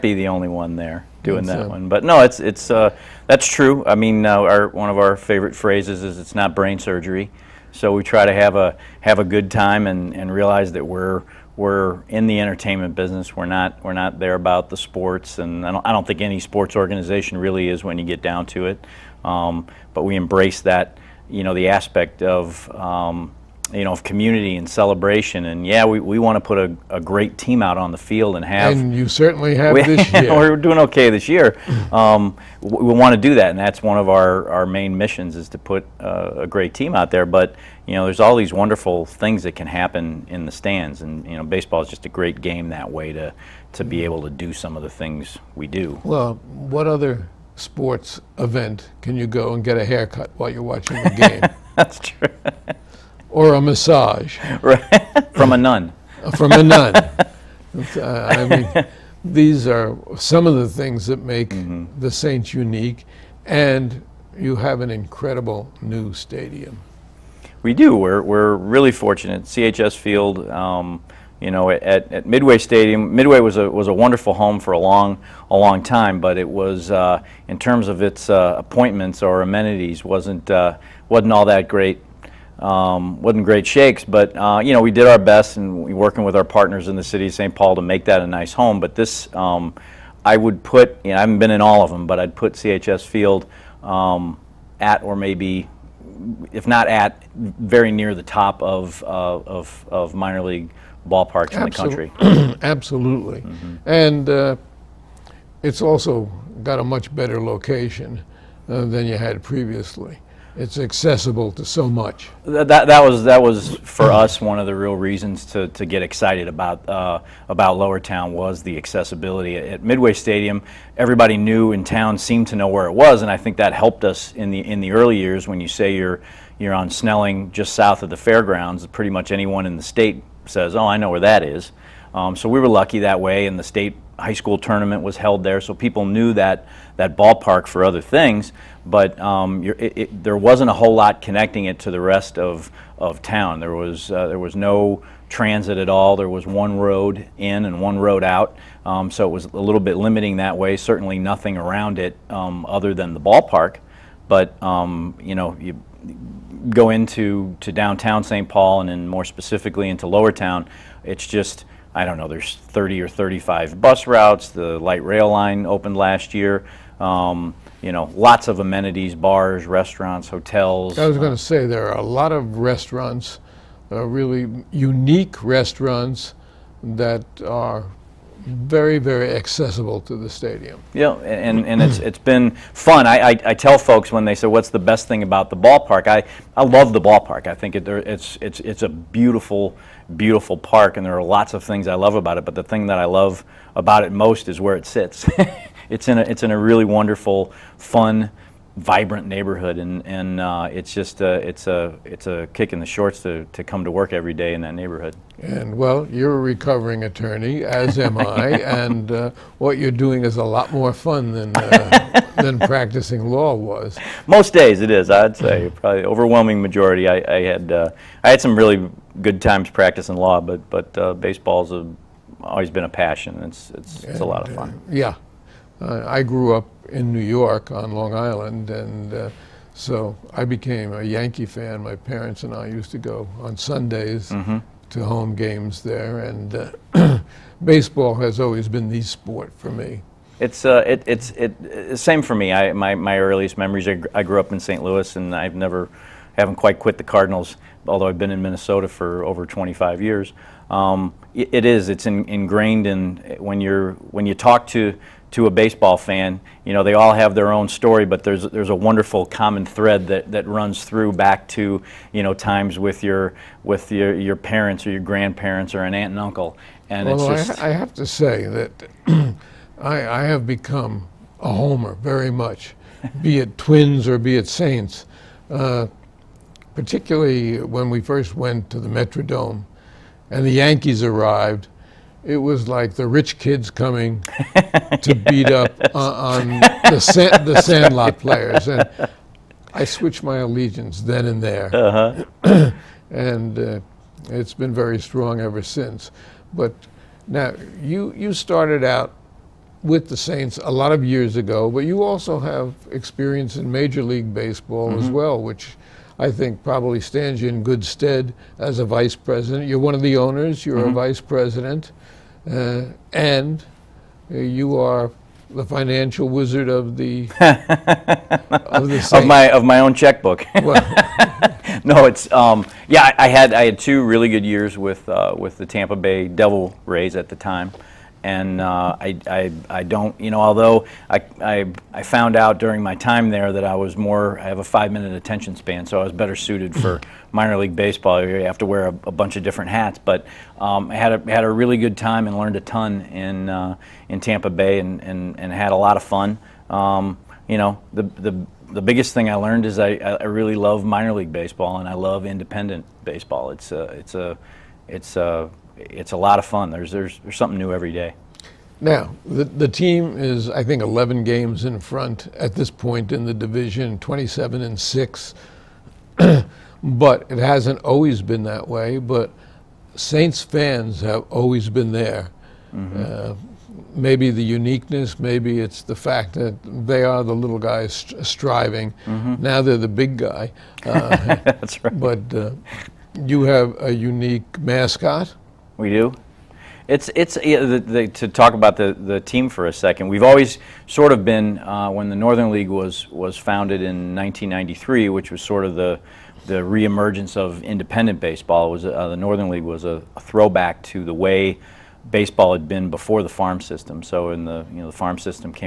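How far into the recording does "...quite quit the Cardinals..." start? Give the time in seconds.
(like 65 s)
246 s.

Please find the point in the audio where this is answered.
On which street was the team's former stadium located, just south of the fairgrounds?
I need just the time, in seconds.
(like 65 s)
126 s.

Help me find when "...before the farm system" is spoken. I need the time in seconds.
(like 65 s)
402 s.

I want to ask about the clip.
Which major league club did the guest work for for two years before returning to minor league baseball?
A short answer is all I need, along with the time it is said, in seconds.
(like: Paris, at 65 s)
Tampa Bay Devil Rays, at 325 s.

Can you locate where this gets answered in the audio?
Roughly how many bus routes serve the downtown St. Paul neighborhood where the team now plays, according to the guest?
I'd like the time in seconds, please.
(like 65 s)
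162 s.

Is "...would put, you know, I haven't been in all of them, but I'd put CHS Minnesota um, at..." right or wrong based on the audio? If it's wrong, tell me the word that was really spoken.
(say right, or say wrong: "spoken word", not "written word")
wrong: "Field", not "Minnesota".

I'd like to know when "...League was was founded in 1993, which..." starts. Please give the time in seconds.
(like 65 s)
392 s.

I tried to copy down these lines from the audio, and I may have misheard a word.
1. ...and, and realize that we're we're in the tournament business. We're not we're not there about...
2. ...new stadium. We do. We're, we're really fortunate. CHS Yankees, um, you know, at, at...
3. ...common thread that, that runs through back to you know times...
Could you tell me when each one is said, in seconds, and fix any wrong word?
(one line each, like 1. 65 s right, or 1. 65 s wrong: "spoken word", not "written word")
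1. 9 s wrong: "entertainment", not "tournament"
2. 65 s wrong: "Field", not "Yankees"
3. 259 s right.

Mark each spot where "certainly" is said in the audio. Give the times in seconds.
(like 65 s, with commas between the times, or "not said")
29 s, 150 s.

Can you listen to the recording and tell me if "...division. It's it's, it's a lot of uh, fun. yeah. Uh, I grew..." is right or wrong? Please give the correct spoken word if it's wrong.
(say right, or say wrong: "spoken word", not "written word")
wrong: "passion", not "division".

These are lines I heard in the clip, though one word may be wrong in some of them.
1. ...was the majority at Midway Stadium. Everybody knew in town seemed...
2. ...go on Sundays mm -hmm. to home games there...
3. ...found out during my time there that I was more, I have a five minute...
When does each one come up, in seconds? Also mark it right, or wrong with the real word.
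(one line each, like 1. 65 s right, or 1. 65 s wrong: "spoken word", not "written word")
1. 118 s wrong: "accessibility", not "majority"
2. 232 s right
3. 332 s right.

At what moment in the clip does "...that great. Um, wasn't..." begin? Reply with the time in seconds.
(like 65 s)
81 s.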